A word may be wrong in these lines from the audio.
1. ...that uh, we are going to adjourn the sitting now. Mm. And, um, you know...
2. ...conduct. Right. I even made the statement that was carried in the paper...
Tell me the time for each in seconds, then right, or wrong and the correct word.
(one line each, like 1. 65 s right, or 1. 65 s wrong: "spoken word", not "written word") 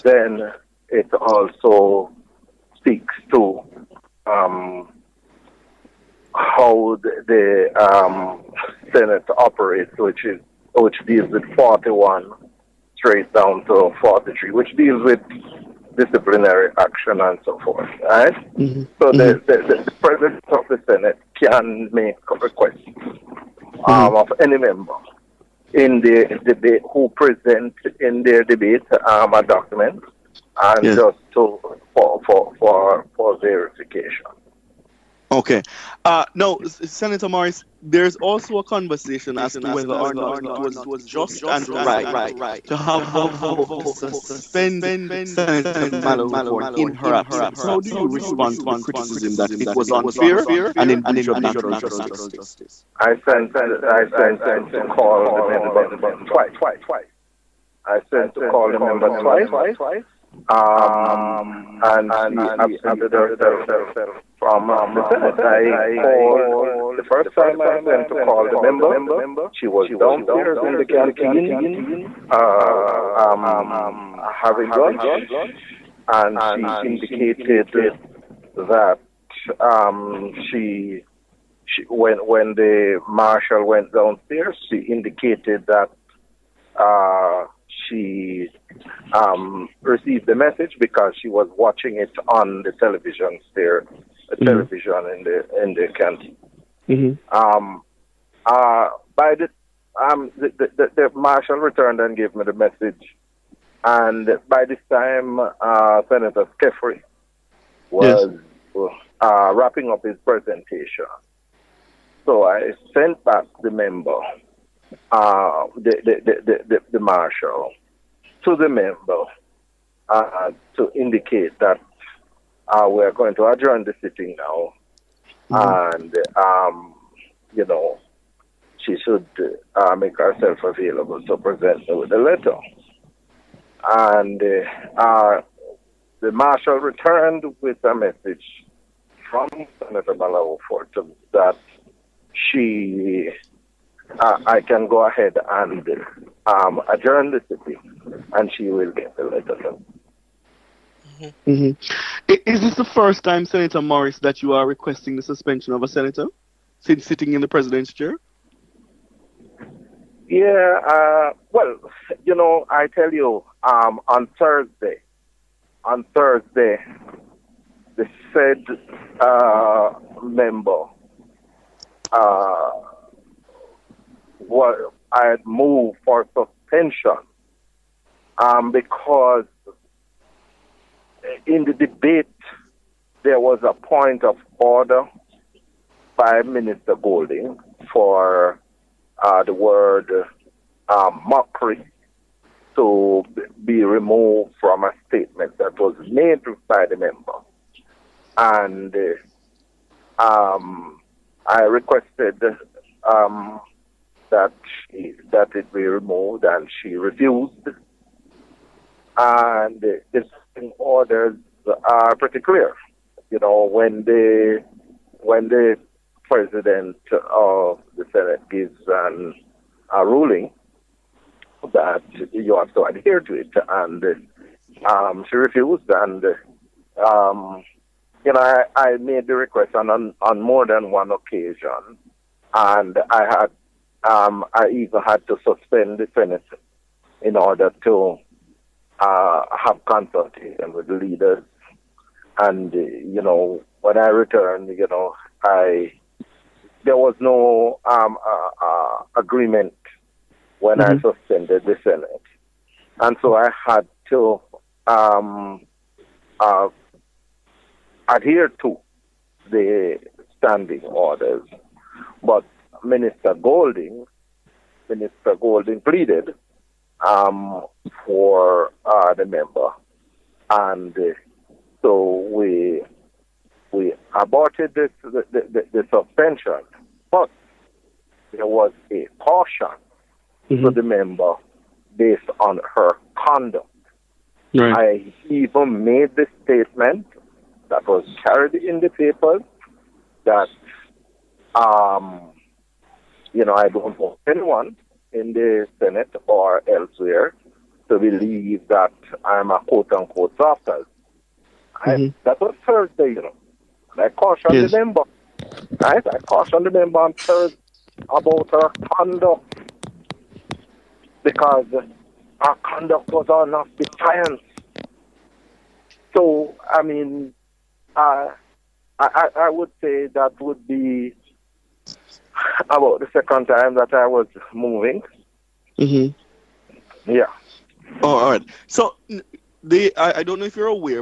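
1. 121 s right
2. 283 s right.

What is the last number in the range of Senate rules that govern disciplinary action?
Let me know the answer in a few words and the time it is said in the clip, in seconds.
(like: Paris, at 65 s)
43, at 13 s.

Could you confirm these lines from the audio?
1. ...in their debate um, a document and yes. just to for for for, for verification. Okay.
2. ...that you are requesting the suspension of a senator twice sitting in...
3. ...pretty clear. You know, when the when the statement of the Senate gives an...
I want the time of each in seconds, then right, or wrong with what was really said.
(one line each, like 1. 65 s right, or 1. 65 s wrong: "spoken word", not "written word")
1. 27 s right
2. 154 s wrong: "since", not "twice"
3. 212 s wrong: "president", not "statement".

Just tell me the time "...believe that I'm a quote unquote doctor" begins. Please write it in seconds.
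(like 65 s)
297 s.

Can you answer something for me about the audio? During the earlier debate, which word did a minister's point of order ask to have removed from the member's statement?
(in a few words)
Mockery.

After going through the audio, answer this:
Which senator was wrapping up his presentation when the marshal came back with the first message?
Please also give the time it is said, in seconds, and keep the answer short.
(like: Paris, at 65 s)
Senator Skeffrey, at 106 s.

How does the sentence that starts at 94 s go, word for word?
television in the in the canteen.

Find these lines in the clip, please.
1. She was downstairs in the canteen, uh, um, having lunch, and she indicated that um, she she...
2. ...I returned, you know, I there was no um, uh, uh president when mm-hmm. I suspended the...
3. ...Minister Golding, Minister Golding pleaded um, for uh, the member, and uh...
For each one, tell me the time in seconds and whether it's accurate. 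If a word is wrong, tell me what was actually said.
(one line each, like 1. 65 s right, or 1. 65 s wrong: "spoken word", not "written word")
1. 69 s right
2. 243 s wrong: "agreement", not "president"
3. 262 s right.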